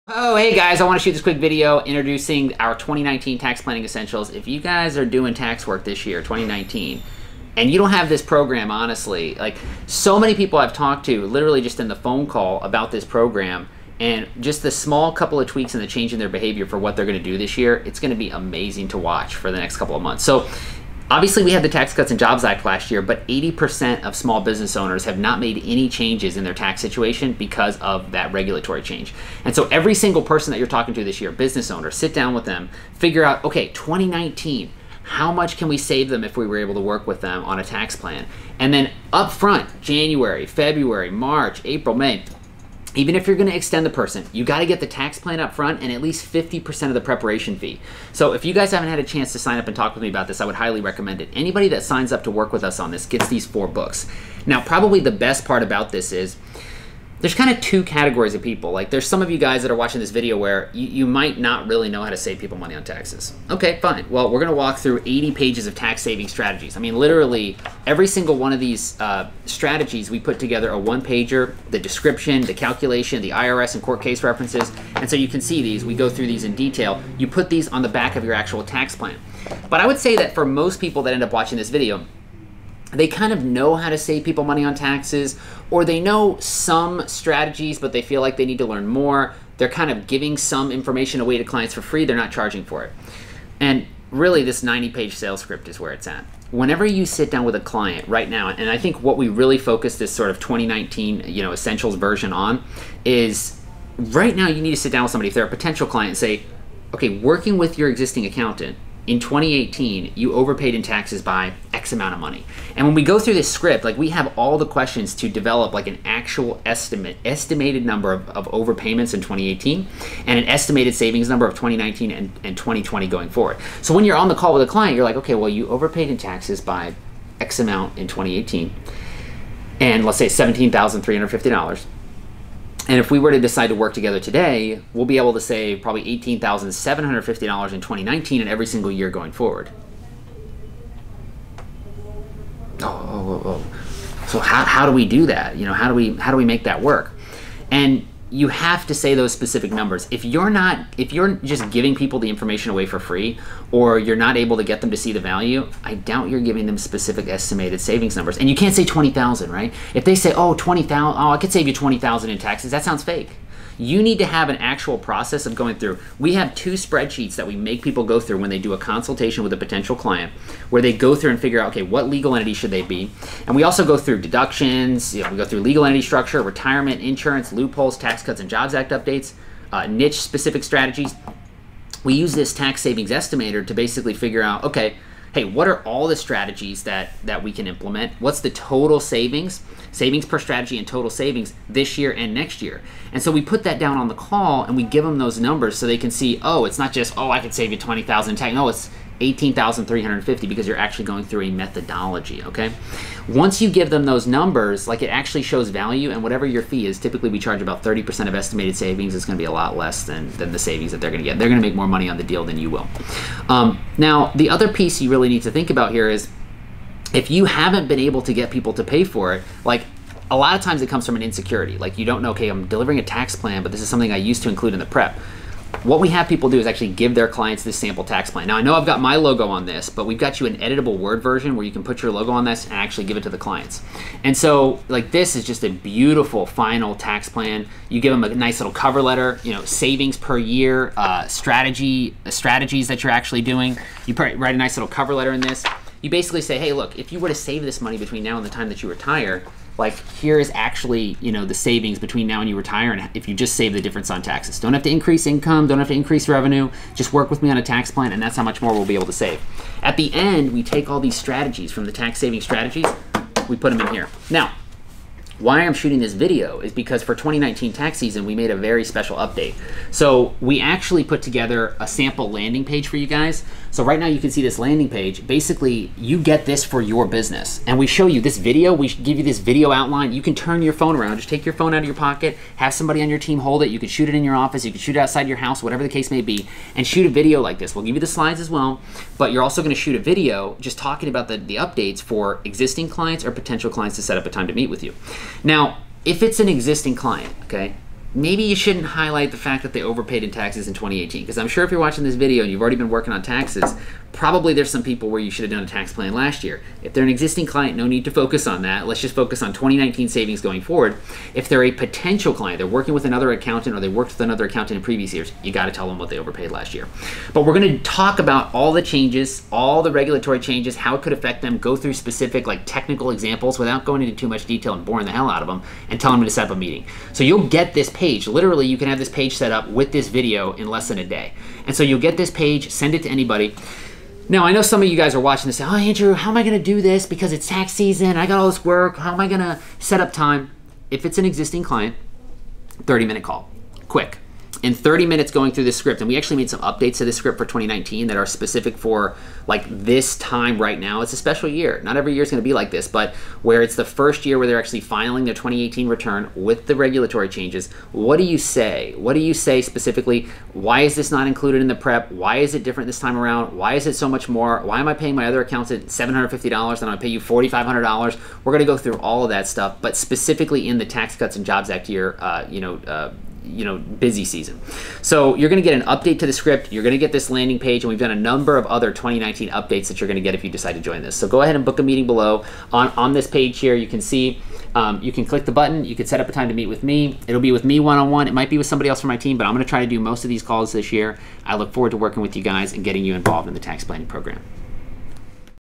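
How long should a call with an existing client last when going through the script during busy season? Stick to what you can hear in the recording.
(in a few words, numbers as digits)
30 minutes.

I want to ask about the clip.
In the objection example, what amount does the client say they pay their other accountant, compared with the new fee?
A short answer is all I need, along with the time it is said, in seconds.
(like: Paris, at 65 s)
$750, at 365 s.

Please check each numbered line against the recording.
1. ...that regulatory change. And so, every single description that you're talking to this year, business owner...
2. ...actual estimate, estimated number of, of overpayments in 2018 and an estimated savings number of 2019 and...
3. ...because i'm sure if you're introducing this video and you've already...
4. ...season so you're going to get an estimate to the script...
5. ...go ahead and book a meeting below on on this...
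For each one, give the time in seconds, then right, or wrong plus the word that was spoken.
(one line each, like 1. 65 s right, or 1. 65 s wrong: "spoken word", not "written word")
1. 28 s wrong: "person", not "description"
2. 116 s right
3. 301 s wrong: "watching", not "introducing"
4. 374 s wrong: "update", not "estimate"
5. 381 s right.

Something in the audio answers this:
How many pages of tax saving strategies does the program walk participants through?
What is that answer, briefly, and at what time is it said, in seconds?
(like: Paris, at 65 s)
80, at 65 s.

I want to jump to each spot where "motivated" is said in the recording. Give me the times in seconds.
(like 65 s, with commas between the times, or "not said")
not said.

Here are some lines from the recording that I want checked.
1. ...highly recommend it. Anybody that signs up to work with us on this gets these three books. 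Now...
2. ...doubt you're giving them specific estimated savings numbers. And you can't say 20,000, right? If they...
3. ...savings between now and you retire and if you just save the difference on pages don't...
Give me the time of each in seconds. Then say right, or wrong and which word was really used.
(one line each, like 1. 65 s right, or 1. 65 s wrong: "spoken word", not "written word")
1. 50 s wrong: "four", not "three"
2. 155 s right
3. 251 s wrong: "taxes", not "pages".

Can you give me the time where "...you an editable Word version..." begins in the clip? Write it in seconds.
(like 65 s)
230 s.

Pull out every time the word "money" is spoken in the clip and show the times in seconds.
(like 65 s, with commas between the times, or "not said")
62 s, 84 s, 112 s, 211 s, 247 s.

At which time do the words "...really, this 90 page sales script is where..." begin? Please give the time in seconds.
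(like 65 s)
94 s.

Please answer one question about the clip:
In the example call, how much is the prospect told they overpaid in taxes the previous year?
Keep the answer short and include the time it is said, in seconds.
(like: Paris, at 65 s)
$17,350, at 130 s.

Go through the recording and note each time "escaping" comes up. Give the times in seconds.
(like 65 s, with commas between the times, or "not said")
not said.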